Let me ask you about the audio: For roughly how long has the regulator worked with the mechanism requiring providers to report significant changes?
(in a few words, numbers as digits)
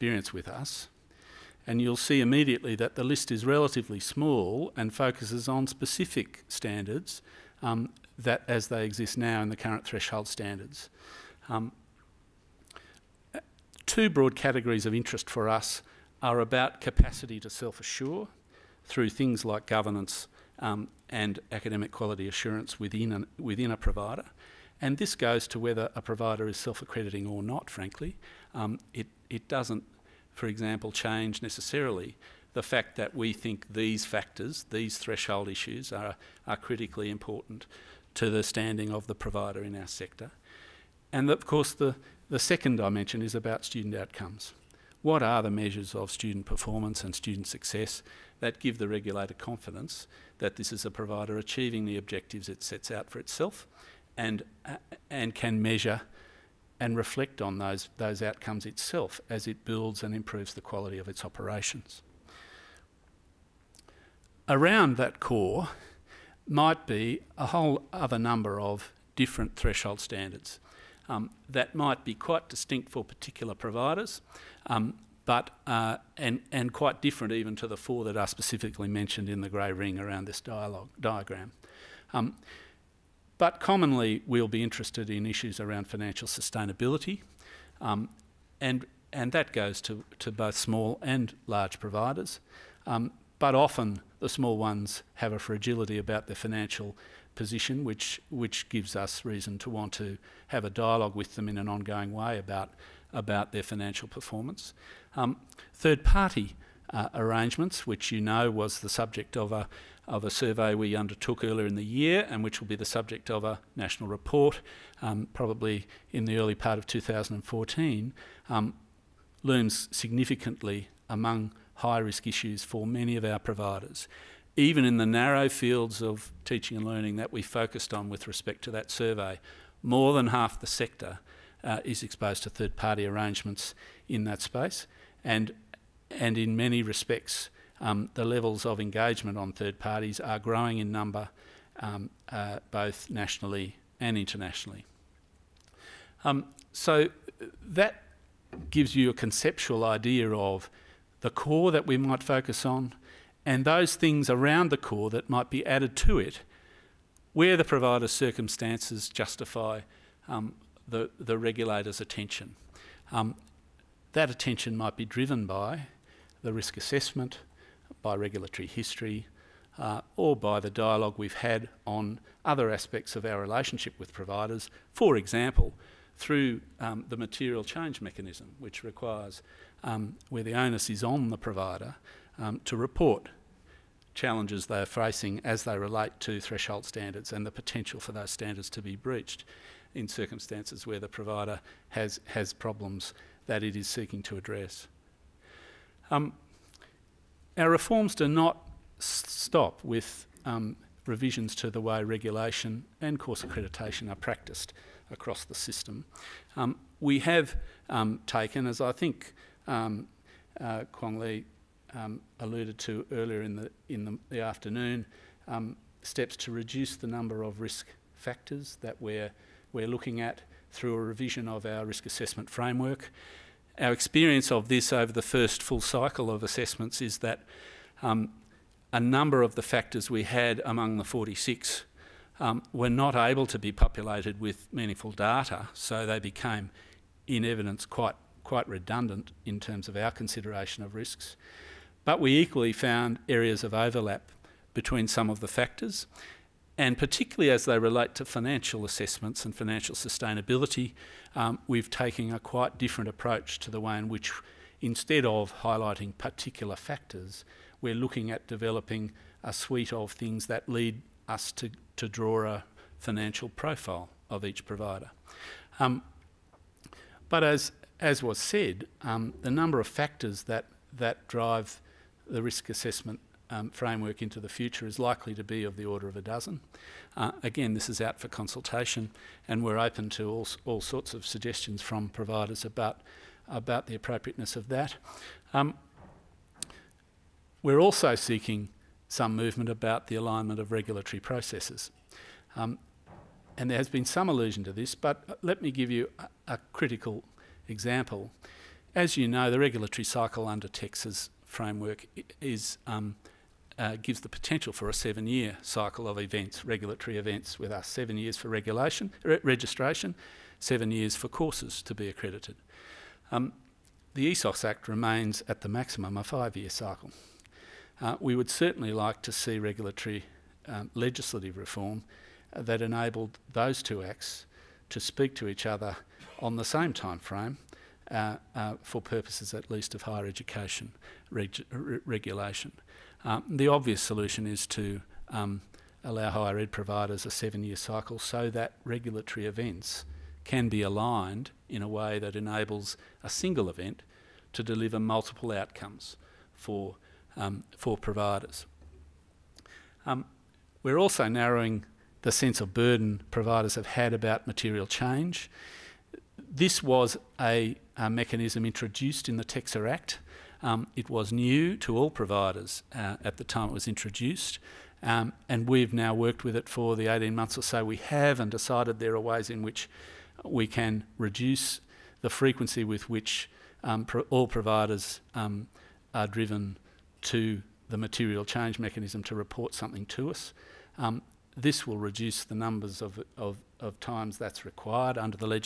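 18 months.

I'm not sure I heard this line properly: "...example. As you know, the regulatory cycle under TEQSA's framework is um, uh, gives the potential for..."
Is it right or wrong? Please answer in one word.
right.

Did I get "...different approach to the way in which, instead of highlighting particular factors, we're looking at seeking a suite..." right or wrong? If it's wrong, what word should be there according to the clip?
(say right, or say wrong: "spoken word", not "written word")
wrong: "developing", not "seeking".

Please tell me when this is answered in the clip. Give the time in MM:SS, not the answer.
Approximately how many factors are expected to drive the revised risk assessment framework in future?
04:36.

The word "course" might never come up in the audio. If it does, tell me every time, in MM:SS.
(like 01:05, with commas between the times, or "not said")
00:41, 03:23, 05:11.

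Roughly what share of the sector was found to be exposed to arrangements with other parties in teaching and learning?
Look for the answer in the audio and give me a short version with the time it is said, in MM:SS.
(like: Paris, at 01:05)
more than half, at 02:09.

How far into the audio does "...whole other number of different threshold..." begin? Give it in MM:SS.
01:07.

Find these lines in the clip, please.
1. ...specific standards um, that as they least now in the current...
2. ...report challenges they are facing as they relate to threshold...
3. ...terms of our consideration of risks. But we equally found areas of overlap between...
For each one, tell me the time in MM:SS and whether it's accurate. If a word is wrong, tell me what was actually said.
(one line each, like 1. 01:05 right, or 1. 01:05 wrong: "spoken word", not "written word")
1. 00:05 wrong: "exist", not "least"
2. 03:02 right
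3. 03:59 right.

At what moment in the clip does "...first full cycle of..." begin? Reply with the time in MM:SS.
03:45.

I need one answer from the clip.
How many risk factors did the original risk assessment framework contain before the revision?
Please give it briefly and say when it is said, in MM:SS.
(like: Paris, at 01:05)
46, at 03:51.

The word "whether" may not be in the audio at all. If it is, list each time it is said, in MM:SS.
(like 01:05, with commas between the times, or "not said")
00:25.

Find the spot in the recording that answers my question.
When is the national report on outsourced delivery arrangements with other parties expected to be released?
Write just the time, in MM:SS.
01:56.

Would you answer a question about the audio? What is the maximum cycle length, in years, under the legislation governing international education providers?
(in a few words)
5 years.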